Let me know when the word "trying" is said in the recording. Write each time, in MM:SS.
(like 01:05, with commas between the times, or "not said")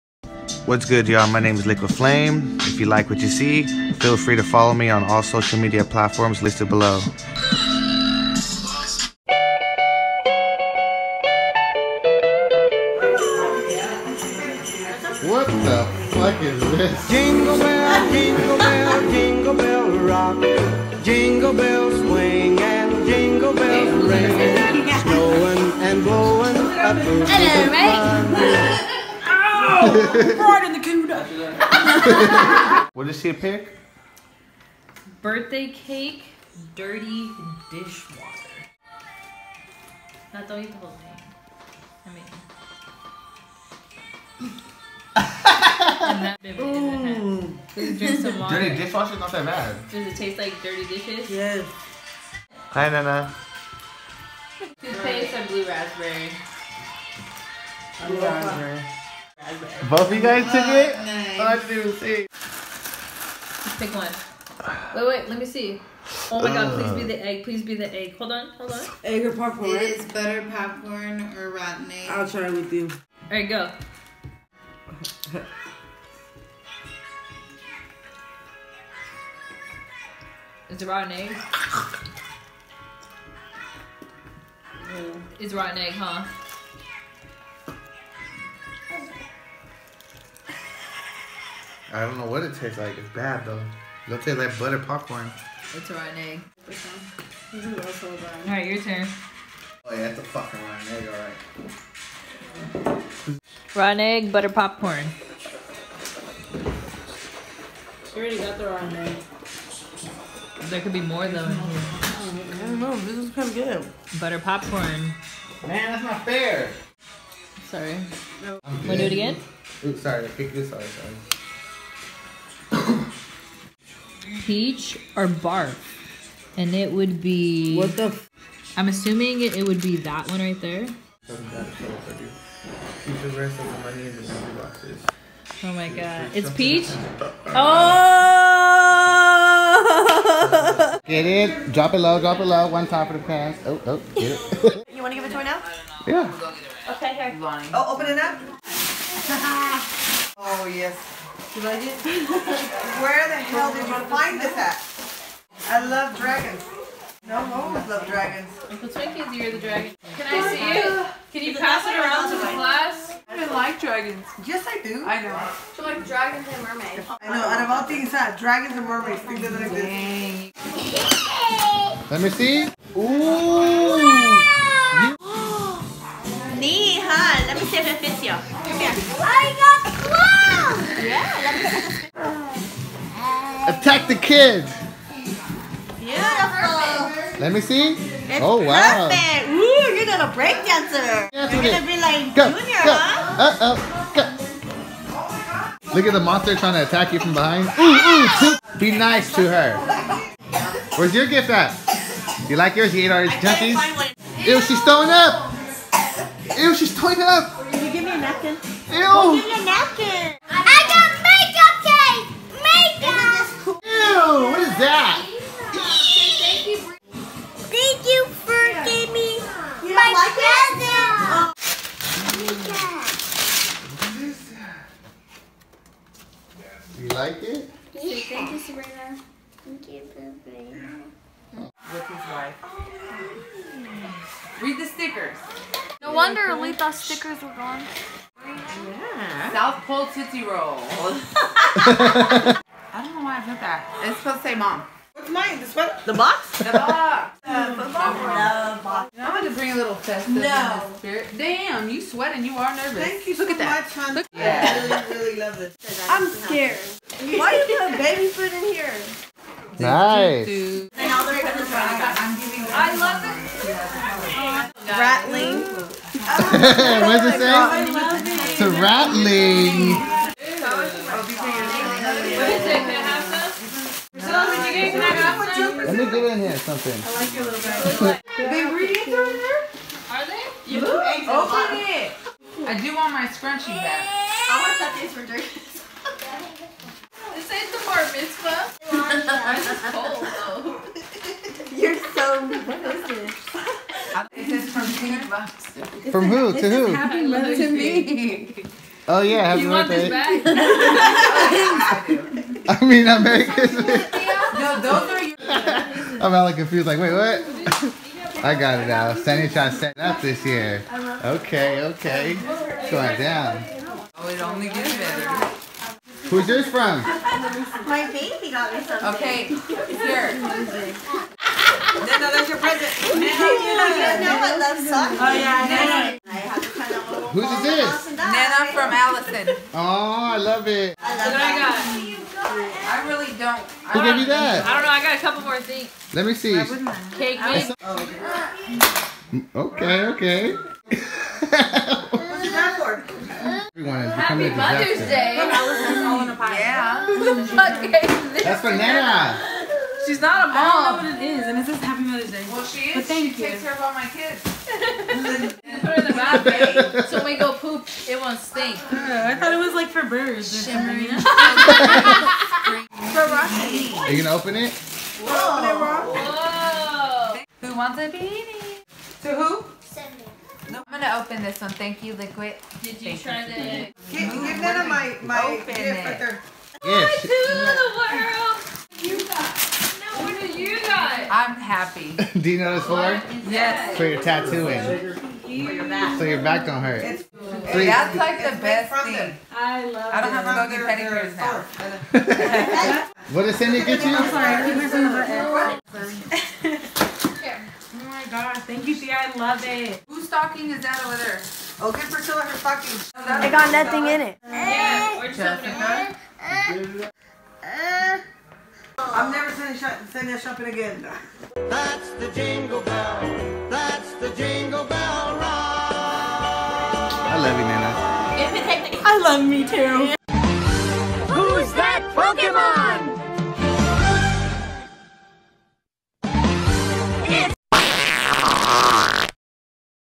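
03:16, 05:09.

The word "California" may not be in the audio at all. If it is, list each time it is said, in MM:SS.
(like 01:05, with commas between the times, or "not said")
not said.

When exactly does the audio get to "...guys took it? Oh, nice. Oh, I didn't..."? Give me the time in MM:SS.
01:00.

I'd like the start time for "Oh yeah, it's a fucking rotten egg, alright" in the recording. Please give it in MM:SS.
01:39.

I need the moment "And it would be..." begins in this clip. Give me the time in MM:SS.
02:06.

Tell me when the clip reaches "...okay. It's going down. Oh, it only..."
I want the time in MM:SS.
05:11.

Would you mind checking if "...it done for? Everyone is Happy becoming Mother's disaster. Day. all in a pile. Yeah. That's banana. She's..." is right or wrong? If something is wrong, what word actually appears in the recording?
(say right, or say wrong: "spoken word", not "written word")
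right.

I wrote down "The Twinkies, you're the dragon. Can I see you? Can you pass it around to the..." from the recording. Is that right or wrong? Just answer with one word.
right.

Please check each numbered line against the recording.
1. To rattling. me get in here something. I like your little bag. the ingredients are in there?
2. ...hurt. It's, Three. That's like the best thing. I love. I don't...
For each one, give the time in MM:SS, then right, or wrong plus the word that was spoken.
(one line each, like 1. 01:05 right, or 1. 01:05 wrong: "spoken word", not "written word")
1. 04:28 right
2. 06:26 right.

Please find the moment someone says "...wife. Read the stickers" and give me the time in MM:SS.
03:52.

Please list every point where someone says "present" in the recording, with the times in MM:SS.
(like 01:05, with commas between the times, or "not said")
03:41, 05:22.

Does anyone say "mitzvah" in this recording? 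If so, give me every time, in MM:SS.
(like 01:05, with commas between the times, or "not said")
04:48.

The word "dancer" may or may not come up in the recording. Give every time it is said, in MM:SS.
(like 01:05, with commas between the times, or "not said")
03:10.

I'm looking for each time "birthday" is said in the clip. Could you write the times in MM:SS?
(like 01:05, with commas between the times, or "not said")
00:35, 04:59.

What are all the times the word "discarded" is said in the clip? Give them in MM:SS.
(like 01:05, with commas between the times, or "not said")
not said.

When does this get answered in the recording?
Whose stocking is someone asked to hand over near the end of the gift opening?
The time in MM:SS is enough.
06:42.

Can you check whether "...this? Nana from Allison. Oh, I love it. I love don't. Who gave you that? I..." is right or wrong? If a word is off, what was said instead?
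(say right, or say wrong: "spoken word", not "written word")
right.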